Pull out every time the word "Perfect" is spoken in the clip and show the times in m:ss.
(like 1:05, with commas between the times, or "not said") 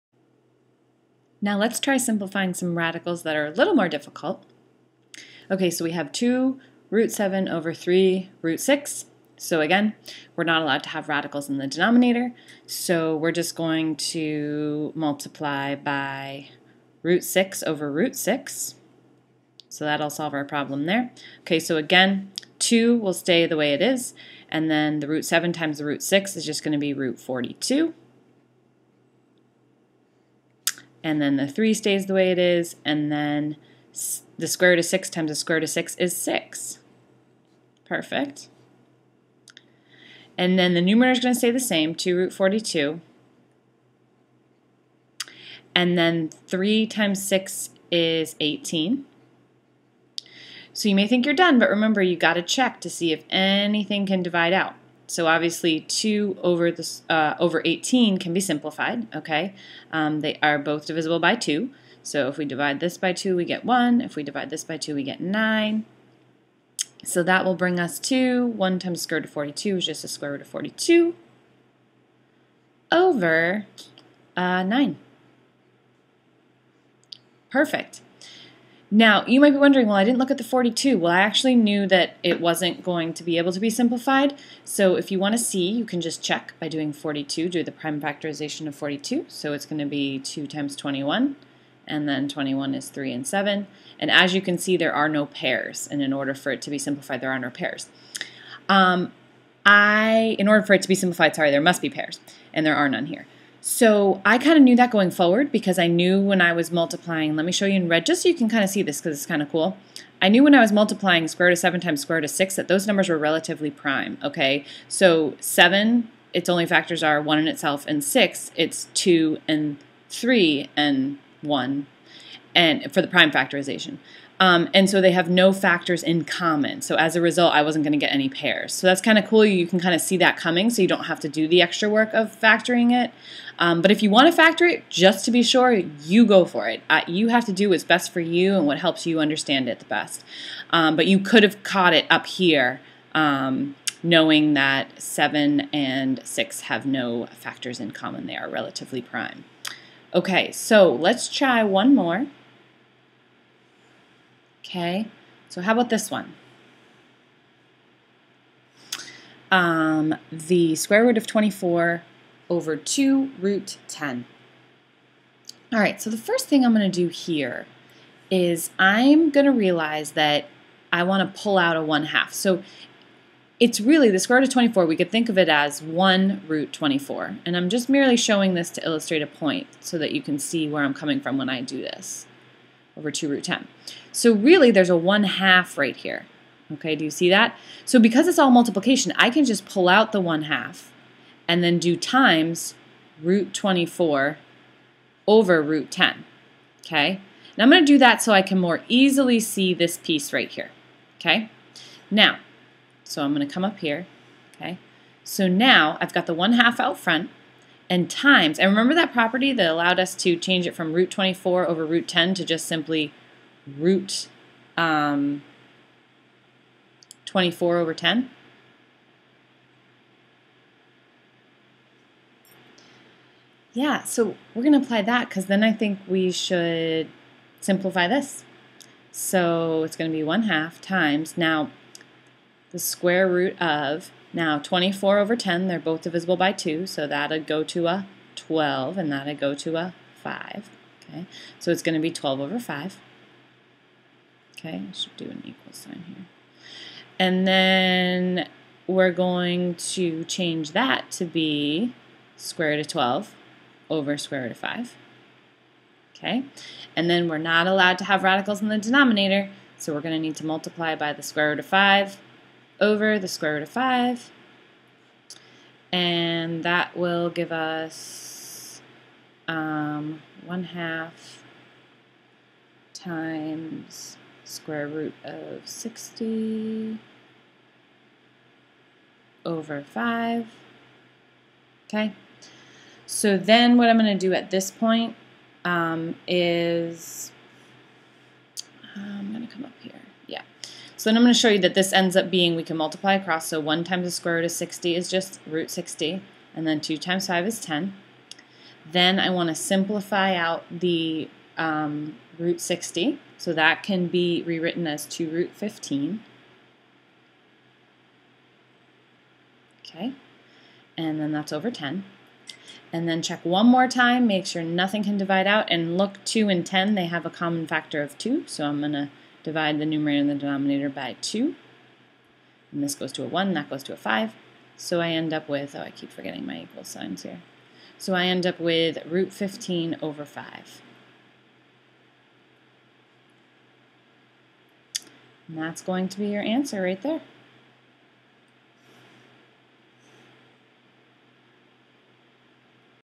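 0:37, 1:17.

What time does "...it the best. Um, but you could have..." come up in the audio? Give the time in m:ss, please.
2:19.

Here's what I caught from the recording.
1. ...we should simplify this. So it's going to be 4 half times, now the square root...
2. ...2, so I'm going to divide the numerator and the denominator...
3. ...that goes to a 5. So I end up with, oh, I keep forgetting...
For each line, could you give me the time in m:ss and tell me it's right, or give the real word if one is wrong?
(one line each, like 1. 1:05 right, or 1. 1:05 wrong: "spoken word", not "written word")
1. 3:46 wrong: "1", not "4"
2. 5:18 right
3. 5:23 right.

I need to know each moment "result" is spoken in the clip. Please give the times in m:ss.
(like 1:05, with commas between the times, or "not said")
2:07.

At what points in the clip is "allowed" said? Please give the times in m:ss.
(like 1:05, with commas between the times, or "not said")
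0:10, 3:29, 4:17.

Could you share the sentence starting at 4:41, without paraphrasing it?
Okay, so then what I'm going to do at this point um, is um, I'm going to come up here.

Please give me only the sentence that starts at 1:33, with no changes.
And as you can see, there are no pairs.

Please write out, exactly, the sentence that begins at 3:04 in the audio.
So really there's a 1 half right here.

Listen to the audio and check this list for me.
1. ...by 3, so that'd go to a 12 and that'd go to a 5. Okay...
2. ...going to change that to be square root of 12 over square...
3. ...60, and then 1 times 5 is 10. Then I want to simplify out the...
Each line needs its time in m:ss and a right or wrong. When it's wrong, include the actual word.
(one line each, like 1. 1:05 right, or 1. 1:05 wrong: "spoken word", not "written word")
1. 3:56 wrong: "2", not "3"
2. 4:09 right
3. 4:55 wrong: "2", not "1".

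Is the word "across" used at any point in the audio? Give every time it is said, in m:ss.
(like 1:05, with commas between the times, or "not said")
4:53.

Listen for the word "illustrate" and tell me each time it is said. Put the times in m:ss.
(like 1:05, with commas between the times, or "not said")
2:58.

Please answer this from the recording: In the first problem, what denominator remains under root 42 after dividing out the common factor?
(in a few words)
9.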